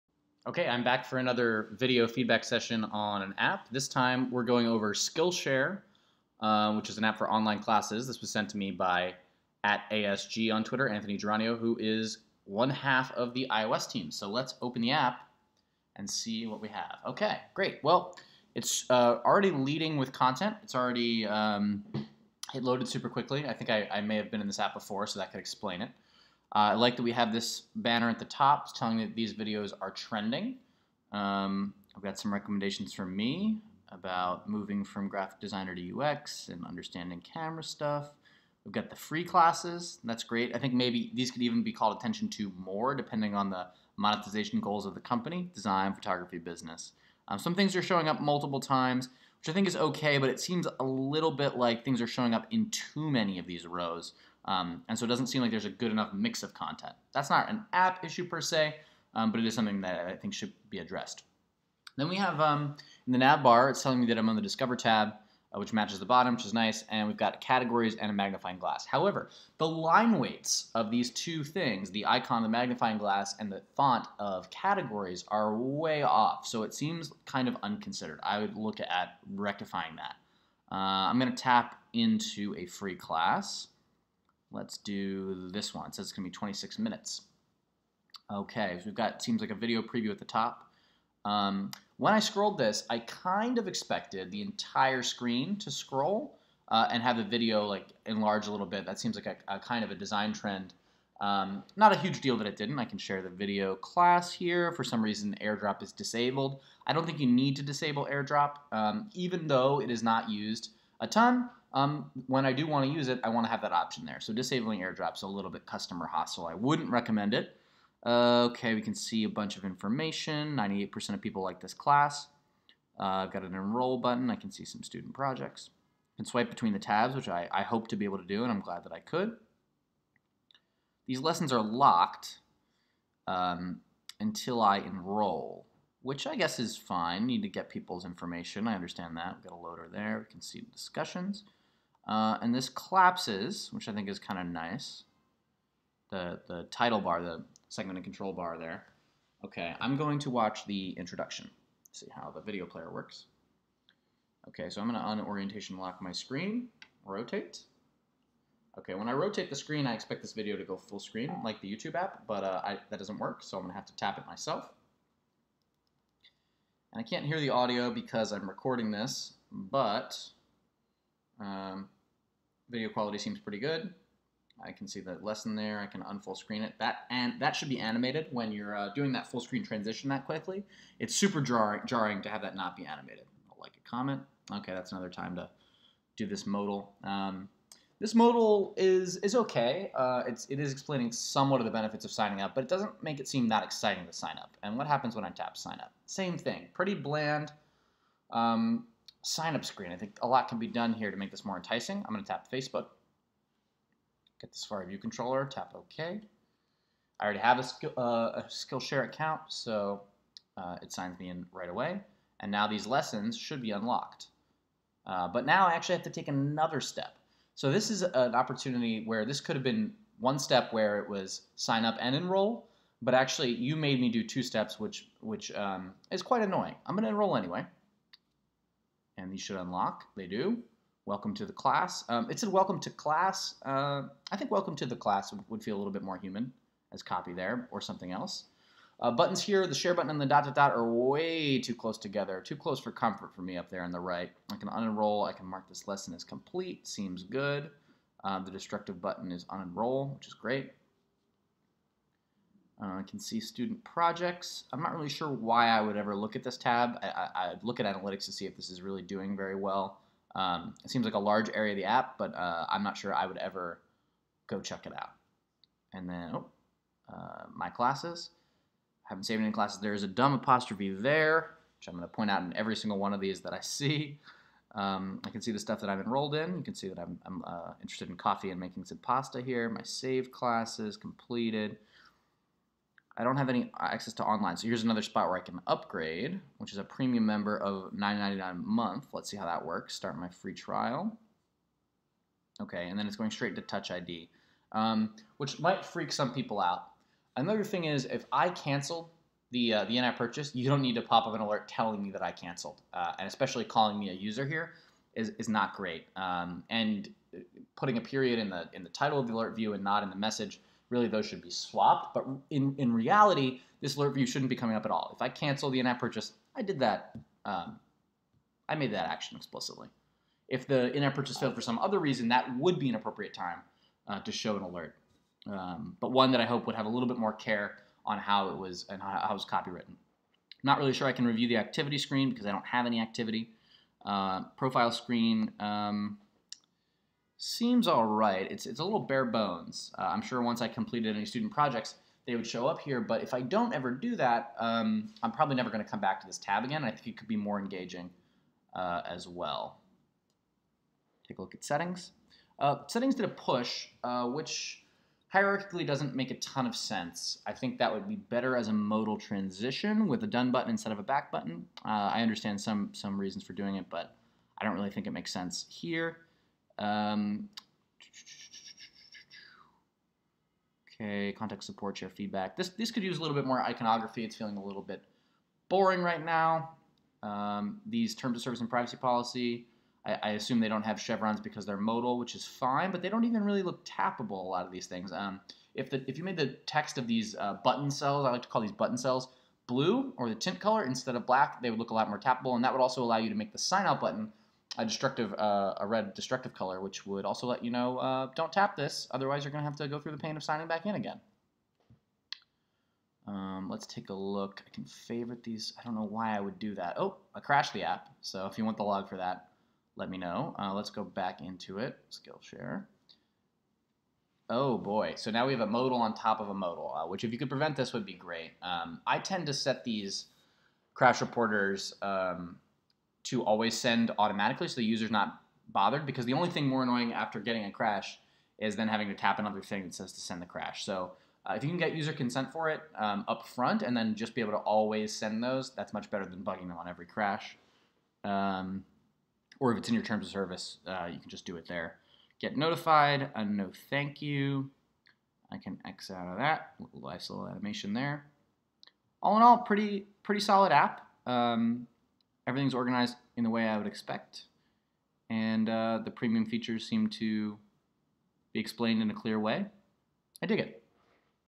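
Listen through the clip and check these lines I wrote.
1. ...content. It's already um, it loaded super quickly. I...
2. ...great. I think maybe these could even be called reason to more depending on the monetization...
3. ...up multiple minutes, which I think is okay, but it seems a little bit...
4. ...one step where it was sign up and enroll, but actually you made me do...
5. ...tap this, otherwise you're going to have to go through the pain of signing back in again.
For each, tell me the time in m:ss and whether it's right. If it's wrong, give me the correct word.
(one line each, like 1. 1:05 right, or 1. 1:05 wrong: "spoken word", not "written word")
1. 0:20 right
2. 0:40 wrong: "attention", not "reason"
3. 0:48 wrong: "times", not "minutes"
4. 3:40 right
5. 6:38 right.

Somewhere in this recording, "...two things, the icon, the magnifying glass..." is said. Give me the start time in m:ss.
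1:11.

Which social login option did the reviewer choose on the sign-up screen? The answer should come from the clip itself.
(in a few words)
Facebook.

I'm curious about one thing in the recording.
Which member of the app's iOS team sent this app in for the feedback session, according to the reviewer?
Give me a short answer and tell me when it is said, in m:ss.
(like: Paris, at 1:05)
Anthony Geranio, at 0:10.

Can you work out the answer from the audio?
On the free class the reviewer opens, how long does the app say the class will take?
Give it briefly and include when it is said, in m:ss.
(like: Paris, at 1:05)
26 minutes, at 1:26.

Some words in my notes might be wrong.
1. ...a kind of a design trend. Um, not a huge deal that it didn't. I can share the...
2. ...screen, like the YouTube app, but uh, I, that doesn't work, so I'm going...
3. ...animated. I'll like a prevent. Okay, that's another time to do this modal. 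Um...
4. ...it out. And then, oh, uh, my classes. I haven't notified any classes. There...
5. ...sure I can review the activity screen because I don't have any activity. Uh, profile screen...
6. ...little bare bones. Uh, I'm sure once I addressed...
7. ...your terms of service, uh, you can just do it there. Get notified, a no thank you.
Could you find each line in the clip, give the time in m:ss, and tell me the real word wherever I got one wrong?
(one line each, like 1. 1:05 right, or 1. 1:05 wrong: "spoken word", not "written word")
1. 1:39 right
2. 2:40 right
3. 3:02 wrong: "comment", not "prevent"
4. 4:24 wrong: "saved", not "notified"
5. 5:30 right
6. 5:38 wrong: "completed", not "addressed"
7. 7:19 right.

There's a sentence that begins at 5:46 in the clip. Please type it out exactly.
I think it could be more engaging uh, as well.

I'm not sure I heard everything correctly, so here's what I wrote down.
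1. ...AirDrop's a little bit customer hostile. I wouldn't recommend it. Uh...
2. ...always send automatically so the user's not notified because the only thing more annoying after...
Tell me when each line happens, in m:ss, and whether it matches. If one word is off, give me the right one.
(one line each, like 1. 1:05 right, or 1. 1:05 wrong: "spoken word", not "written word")
1. 1:54 right
2. 7:03 wrong: "bothered", not "notified".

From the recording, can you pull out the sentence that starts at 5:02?
Uh, and especially calling me a user here is, is not great.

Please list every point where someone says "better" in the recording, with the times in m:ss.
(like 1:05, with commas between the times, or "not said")
5:58, 7:16.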